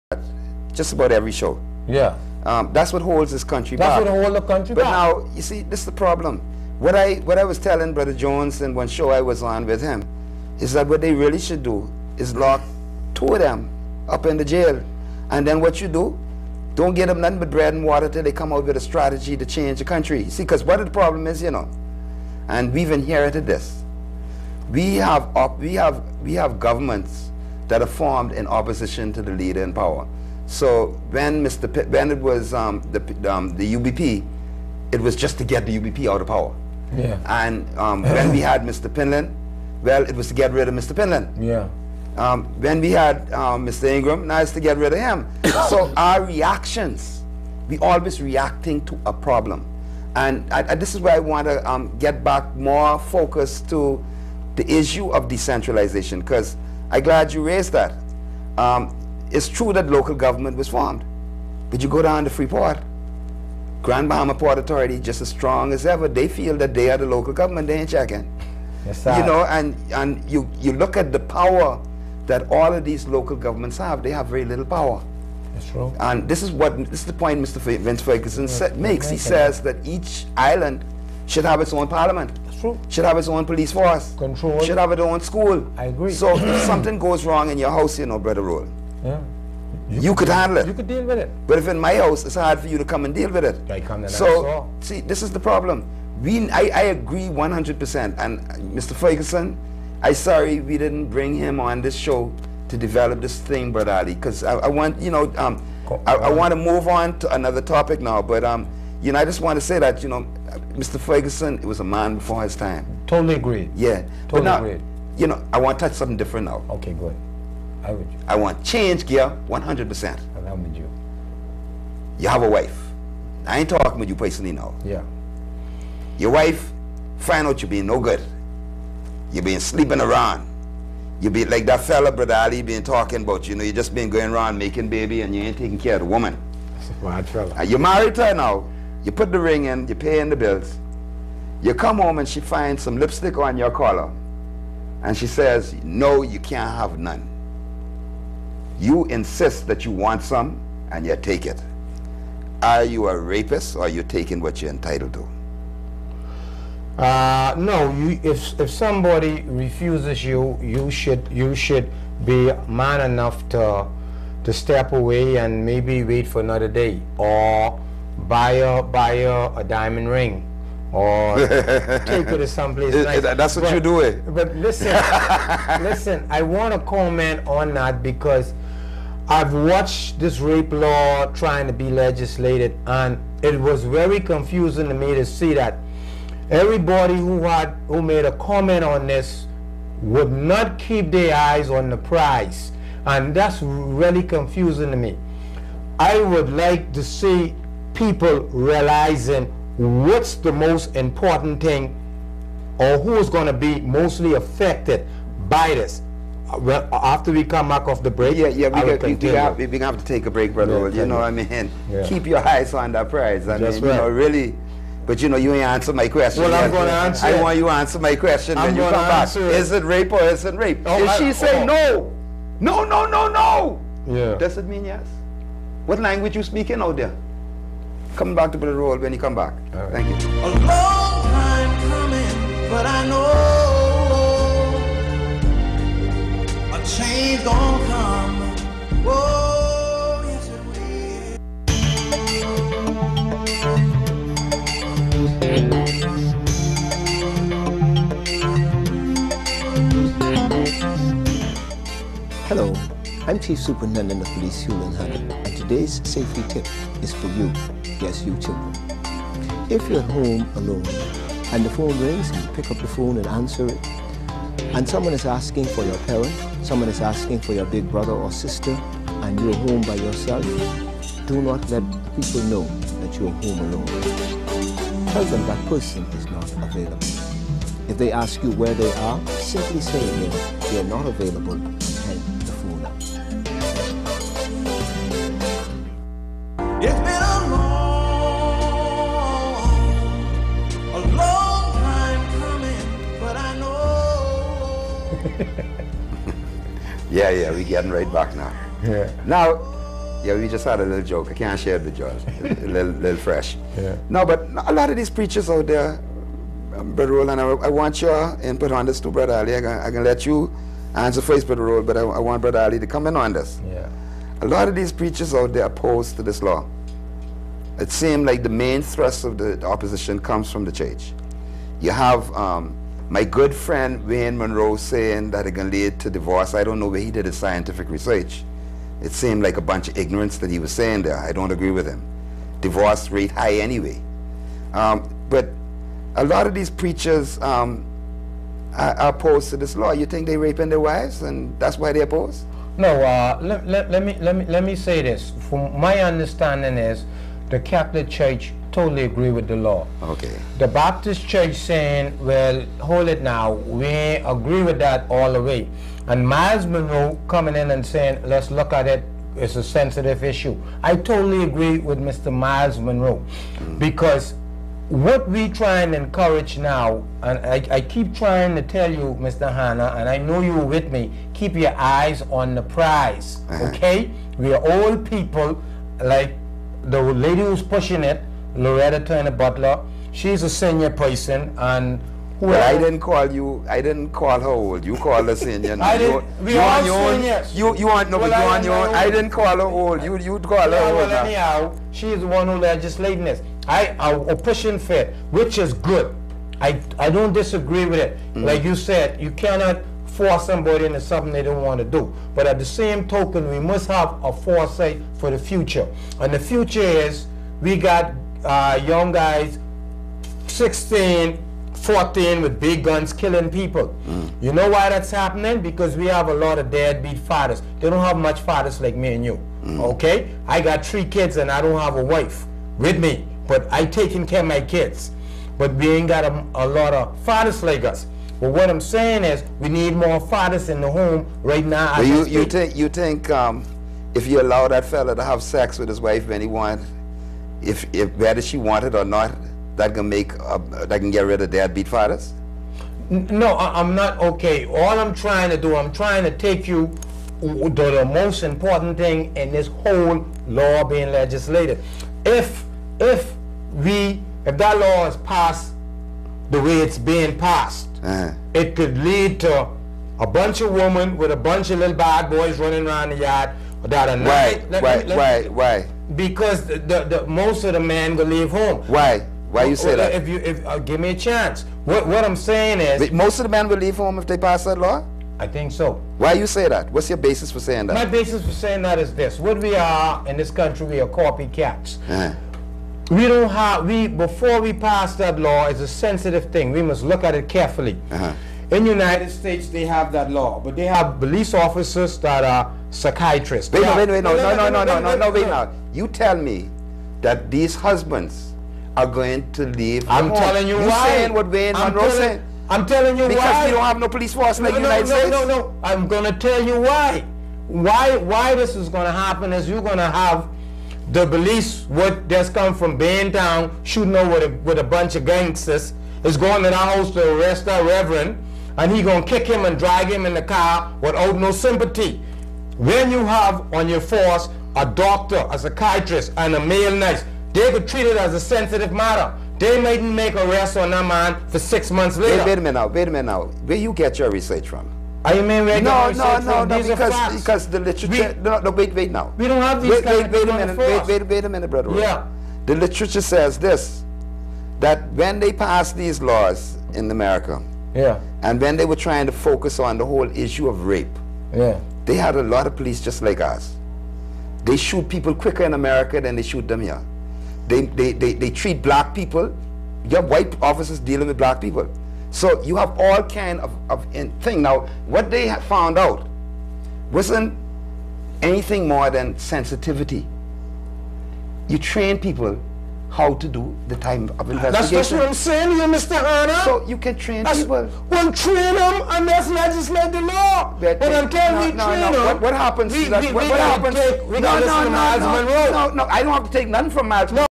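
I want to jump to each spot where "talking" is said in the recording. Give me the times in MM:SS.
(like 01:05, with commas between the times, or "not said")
02:03, 02:12.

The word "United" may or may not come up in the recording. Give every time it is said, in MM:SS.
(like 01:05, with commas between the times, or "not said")
08:08, 08:24.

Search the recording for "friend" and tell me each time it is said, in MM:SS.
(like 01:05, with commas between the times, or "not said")
05:23.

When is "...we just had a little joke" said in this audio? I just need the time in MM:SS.
05:00.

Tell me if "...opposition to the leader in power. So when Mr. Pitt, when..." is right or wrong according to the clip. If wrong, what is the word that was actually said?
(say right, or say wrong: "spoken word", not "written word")
right.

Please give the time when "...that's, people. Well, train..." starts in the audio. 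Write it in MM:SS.
09:37.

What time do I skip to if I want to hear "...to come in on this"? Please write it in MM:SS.
05:12.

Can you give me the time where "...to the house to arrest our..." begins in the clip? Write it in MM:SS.
08:36.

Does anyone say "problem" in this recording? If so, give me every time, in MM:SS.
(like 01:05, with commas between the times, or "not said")
00:05, 00:20, 00:49, 01:35.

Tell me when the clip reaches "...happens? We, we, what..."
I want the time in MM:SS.
09:42.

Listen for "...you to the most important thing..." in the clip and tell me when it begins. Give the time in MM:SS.
07:26.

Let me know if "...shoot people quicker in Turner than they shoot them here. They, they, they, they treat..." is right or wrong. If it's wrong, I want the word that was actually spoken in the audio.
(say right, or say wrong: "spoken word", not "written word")
wrong: "America", not "Turner".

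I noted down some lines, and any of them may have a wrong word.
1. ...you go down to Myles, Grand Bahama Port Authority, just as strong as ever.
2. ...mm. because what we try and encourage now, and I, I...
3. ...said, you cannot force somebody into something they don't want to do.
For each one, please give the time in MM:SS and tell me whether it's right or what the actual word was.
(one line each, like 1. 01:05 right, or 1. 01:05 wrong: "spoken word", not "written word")
1. 01:01 wrong: "Freeport", not "Myles"
2. 06:03 right
3. 06:38 right.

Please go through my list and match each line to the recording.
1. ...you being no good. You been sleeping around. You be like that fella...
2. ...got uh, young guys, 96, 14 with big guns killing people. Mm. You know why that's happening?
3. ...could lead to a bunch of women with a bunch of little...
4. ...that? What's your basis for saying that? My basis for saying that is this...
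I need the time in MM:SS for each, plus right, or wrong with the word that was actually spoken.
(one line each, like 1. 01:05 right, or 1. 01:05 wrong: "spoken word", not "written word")
1. 02:07 right
2. 06:47 wrong: "16", not "96"
3. 07:38 right
4. 07:56 right.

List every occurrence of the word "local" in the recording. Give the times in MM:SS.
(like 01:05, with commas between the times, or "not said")
00:59, 01:07, 01:13.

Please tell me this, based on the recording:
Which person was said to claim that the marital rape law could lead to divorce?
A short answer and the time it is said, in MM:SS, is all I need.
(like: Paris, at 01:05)
Wayne Munroe, at 05:24.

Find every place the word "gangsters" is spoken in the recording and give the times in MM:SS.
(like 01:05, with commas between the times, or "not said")
08:35.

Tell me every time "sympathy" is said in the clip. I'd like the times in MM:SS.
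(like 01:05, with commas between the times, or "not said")
08:41.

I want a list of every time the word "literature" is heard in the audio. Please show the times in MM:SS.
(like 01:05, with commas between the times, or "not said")
08:57, 09:02.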